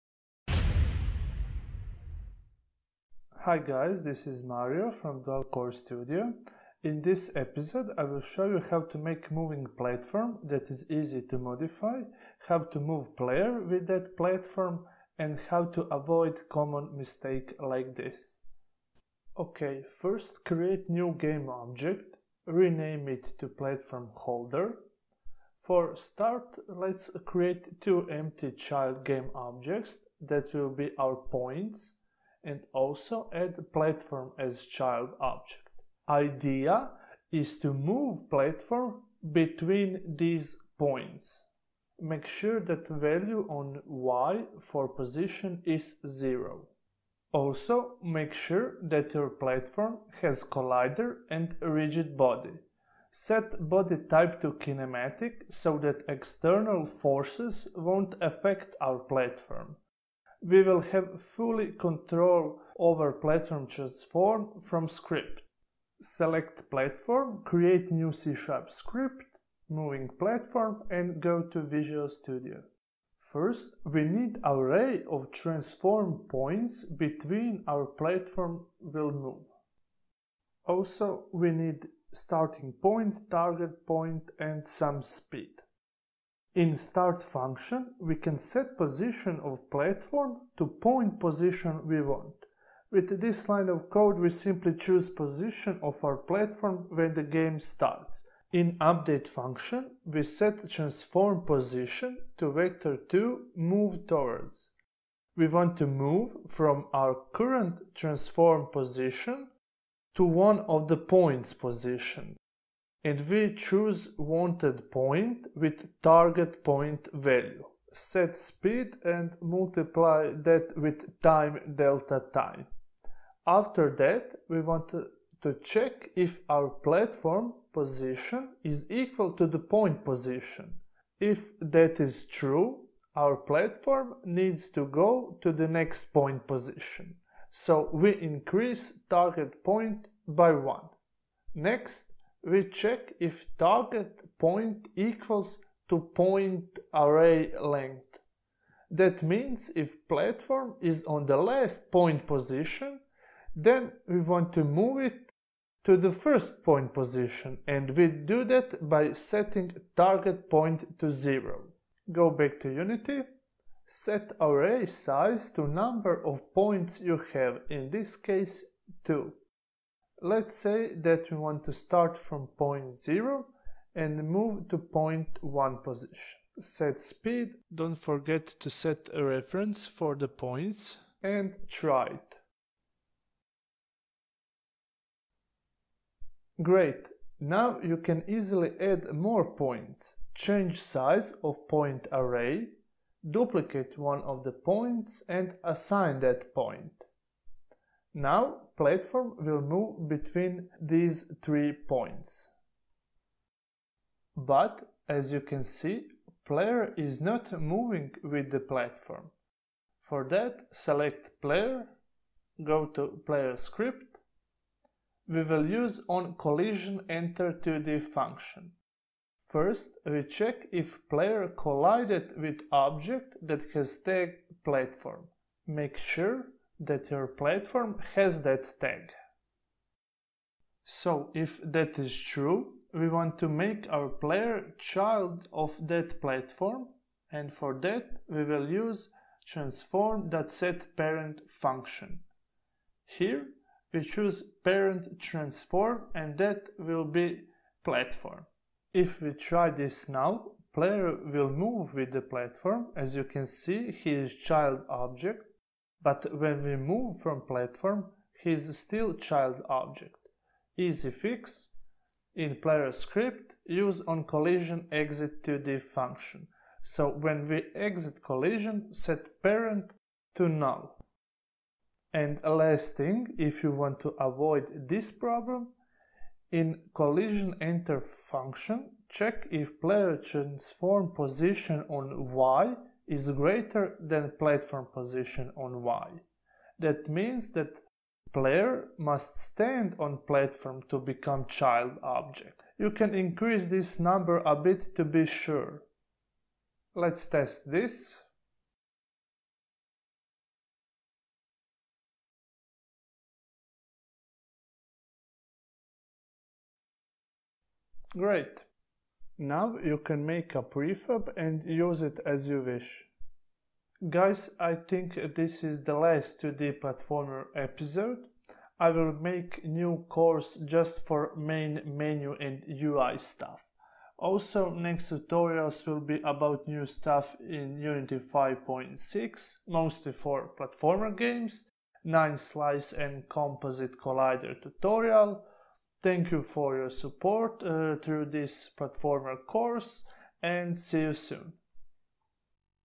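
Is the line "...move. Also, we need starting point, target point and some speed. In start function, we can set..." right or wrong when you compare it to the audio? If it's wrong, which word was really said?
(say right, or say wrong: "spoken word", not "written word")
right.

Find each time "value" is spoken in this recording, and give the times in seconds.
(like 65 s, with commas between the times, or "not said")
42 s, 117 s.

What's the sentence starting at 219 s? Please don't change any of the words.
First, we check if player collided with object that has tag platform.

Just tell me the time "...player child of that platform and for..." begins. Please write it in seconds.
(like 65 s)
234 s.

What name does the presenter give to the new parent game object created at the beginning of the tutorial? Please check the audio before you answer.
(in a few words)
platform holder.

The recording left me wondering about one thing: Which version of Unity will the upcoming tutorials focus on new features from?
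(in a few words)
Unity 5.6.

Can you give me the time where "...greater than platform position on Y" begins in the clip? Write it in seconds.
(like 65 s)
283 s.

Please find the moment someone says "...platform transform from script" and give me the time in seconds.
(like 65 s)
63 s.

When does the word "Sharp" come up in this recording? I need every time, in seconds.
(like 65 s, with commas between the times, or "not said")
68 s.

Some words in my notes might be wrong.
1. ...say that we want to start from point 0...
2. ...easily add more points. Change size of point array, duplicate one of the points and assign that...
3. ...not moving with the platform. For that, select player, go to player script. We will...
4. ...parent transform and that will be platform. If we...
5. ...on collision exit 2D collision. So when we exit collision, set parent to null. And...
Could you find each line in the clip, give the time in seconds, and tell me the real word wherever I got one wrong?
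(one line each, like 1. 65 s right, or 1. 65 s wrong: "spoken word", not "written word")
1. 170 s right
2. 188 s right
3. 207 s right
4. 244 s right
5. 264 s wrong: "function", not "collision".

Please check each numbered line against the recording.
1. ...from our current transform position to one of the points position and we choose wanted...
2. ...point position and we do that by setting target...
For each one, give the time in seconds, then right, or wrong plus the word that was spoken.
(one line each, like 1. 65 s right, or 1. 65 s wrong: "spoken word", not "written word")
1. 106 s right
2. 156 s right.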